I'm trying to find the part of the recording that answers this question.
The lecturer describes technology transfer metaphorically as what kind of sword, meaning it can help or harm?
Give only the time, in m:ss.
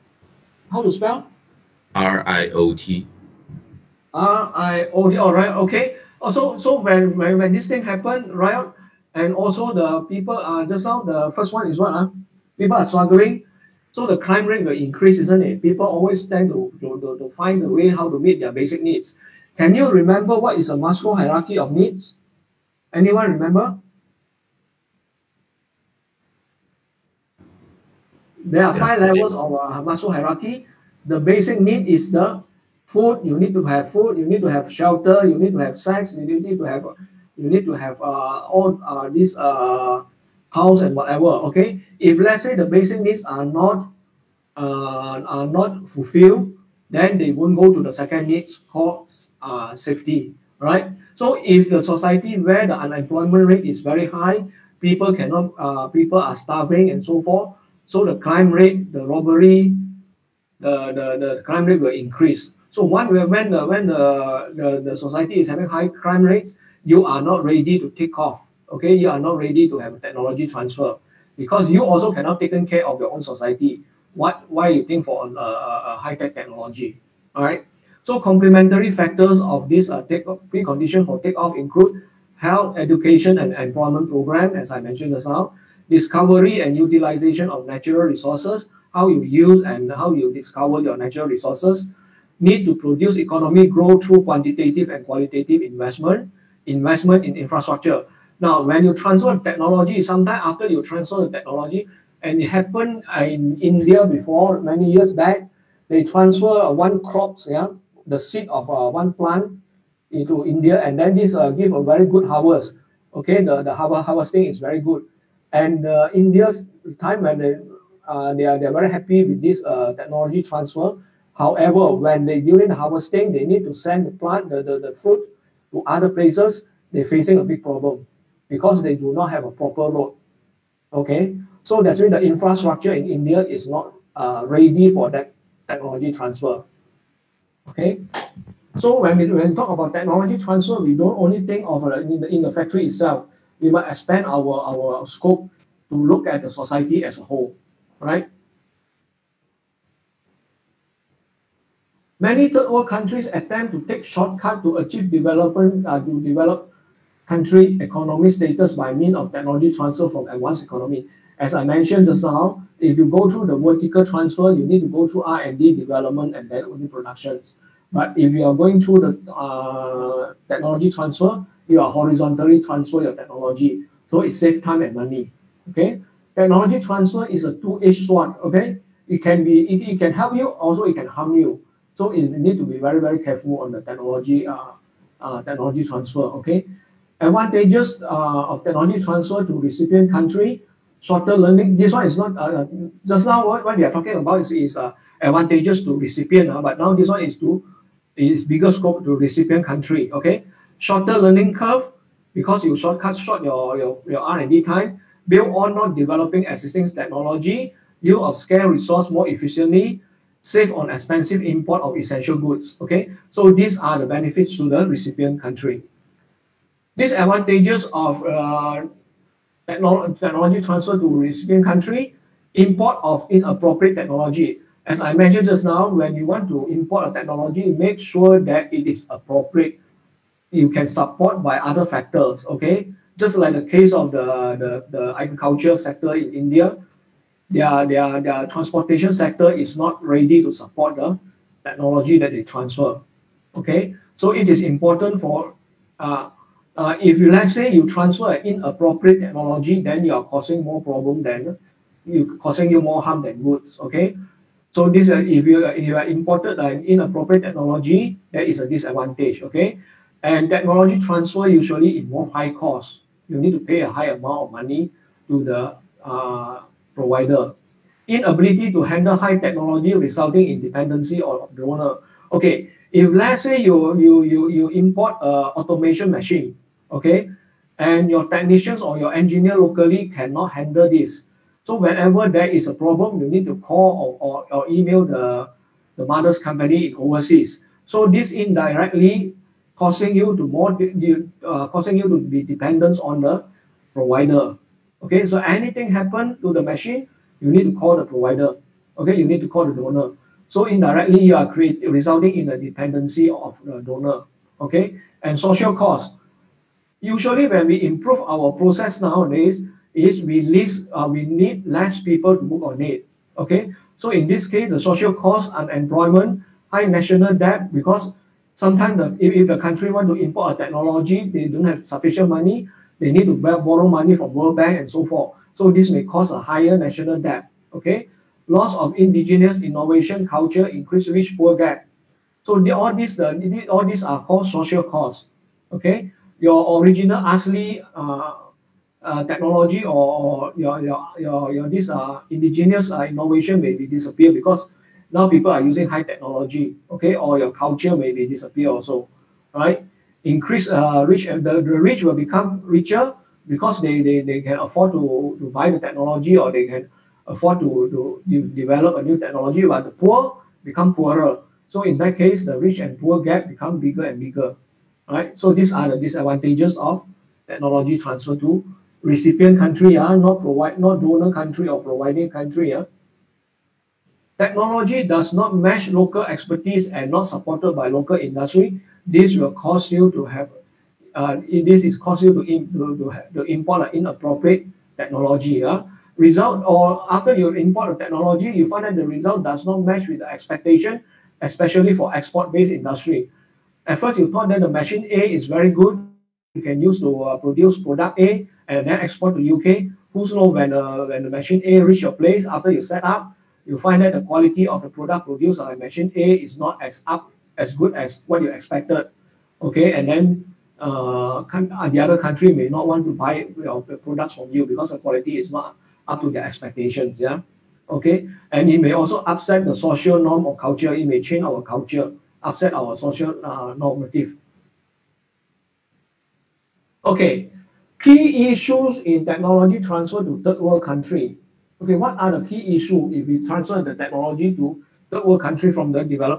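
2:57.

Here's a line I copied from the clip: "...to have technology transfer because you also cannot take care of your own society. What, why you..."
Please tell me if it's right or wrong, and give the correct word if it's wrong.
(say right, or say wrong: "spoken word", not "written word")
right.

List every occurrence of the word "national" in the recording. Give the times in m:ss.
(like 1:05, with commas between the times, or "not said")
5:16, 5:26.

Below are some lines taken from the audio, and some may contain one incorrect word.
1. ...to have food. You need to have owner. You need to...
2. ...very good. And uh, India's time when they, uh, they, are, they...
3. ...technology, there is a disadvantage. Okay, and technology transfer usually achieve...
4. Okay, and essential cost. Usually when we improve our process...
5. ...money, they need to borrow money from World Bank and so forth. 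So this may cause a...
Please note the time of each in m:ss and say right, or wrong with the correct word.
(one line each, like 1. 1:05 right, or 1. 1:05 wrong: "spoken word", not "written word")
1. 0:33 wrong: "shelter", not "owner"
2. 1:54 right
3. 4:17 wrong: "involve", not "achieve"
4. 5:04 wrong: "social", not "essential"
5. 5:22 right.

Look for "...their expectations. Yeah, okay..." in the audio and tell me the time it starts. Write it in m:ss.
6:56.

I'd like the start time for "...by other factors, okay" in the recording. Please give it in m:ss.
3:51.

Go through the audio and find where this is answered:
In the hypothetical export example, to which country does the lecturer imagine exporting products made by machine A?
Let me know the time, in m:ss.
6:39.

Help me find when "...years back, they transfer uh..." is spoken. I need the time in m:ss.
1:44.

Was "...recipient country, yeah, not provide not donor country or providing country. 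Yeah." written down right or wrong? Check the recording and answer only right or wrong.
right.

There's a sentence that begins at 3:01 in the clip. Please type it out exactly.
So you need to be very, very careful on the technology uh, uh, technology transfer.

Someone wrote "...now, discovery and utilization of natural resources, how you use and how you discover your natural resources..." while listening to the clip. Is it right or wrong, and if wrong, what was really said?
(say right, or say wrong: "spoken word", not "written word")
right.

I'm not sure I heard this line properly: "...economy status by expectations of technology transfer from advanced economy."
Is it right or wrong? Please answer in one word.
wrong.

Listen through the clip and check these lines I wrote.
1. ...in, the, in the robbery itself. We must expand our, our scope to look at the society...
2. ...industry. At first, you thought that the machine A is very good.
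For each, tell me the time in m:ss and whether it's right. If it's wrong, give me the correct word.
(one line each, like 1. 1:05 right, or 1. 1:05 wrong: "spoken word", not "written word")
1. 2:21 wrong: "factory", not "robbery"
2. 6:32 right.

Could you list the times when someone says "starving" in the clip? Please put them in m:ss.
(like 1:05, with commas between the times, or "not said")
0:56.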